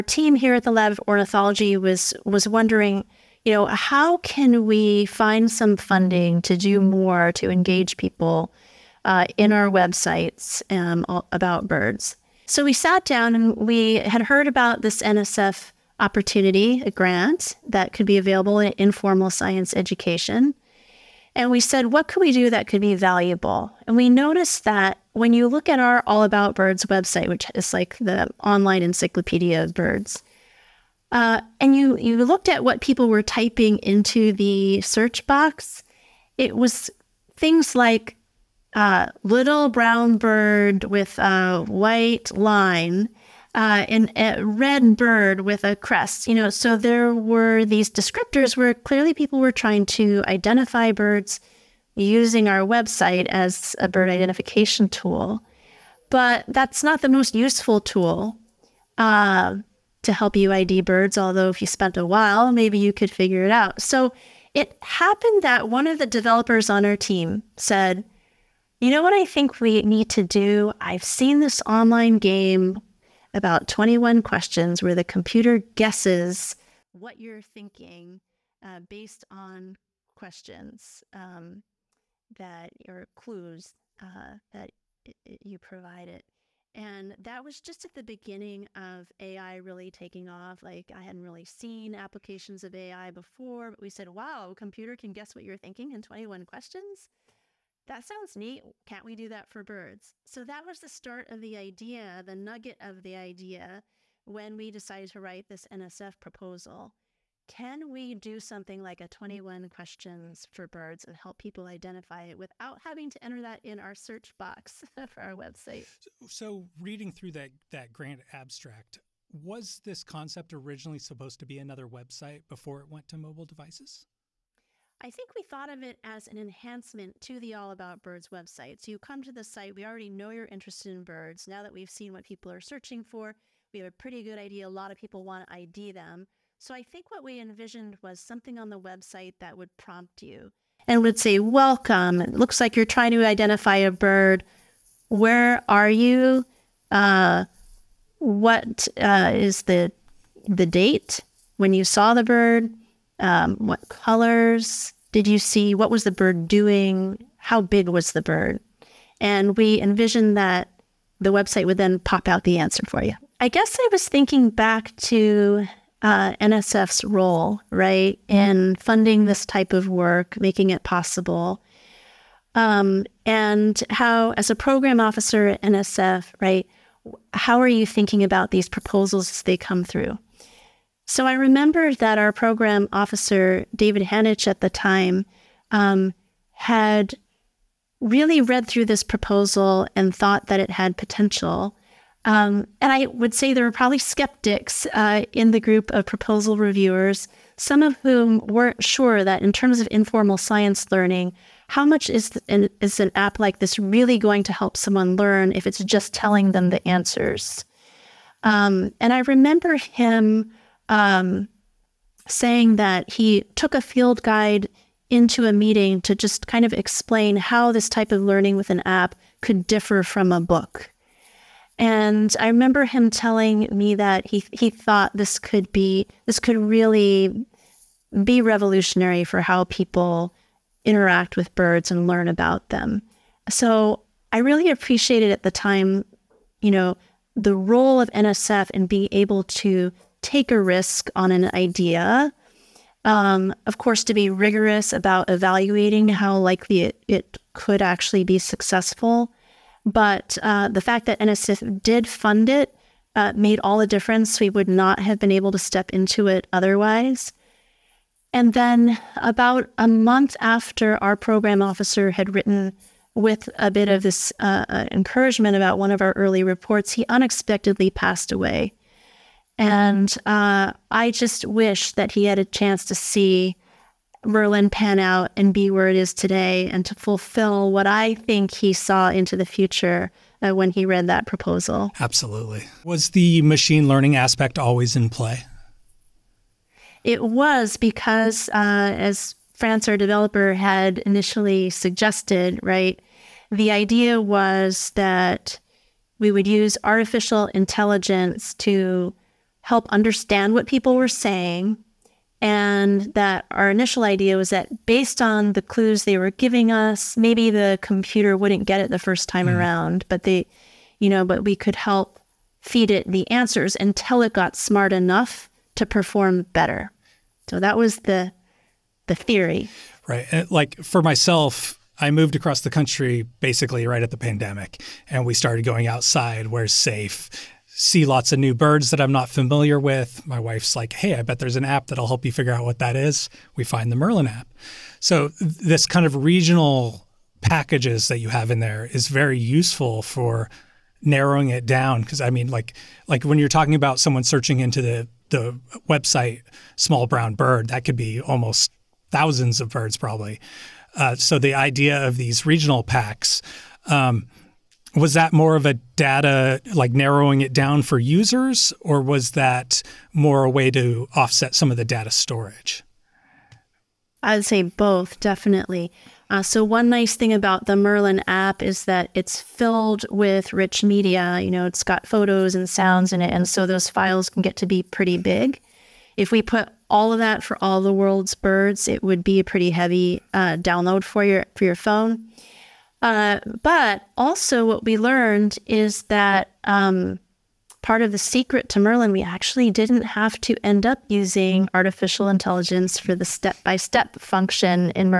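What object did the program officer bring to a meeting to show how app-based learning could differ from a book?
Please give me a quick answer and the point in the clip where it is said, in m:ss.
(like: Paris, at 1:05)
a field guide, at 3:33.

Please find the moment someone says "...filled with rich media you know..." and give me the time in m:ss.
6:09.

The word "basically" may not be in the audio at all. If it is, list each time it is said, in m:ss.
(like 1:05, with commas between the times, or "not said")
5:23.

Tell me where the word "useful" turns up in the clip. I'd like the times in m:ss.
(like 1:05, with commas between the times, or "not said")
0:57, 5:39.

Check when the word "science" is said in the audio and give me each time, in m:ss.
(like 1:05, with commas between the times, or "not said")
0:19, 3:20.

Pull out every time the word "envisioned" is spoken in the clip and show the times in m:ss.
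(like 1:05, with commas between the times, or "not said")
2:17, 2:39.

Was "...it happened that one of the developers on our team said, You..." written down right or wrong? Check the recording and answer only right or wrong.
right.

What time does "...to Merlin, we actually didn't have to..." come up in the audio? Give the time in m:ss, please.
6:28.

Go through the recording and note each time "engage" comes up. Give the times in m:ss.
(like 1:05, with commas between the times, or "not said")
0:07.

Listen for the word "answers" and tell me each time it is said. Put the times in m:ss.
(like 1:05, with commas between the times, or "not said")
2:42, 3:26, 5:13.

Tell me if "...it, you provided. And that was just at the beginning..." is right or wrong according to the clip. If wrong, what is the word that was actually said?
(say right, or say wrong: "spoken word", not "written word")
right.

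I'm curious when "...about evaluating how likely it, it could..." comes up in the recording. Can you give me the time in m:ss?
4:04.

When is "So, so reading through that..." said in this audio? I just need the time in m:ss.
1:56.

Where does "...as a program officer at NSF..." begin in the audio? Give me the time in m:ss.
2:54.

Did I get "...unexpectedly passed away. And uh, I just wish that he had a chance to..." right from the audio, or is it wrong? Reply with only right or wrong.
right.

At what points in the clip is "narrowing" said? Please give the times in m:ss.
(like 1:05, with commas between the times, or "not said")
5:41, 5:56.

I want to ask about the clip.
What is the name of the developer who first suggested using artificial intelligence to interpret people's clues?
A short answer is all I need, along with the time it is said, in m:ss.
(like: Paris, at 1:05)
France, at 4:49.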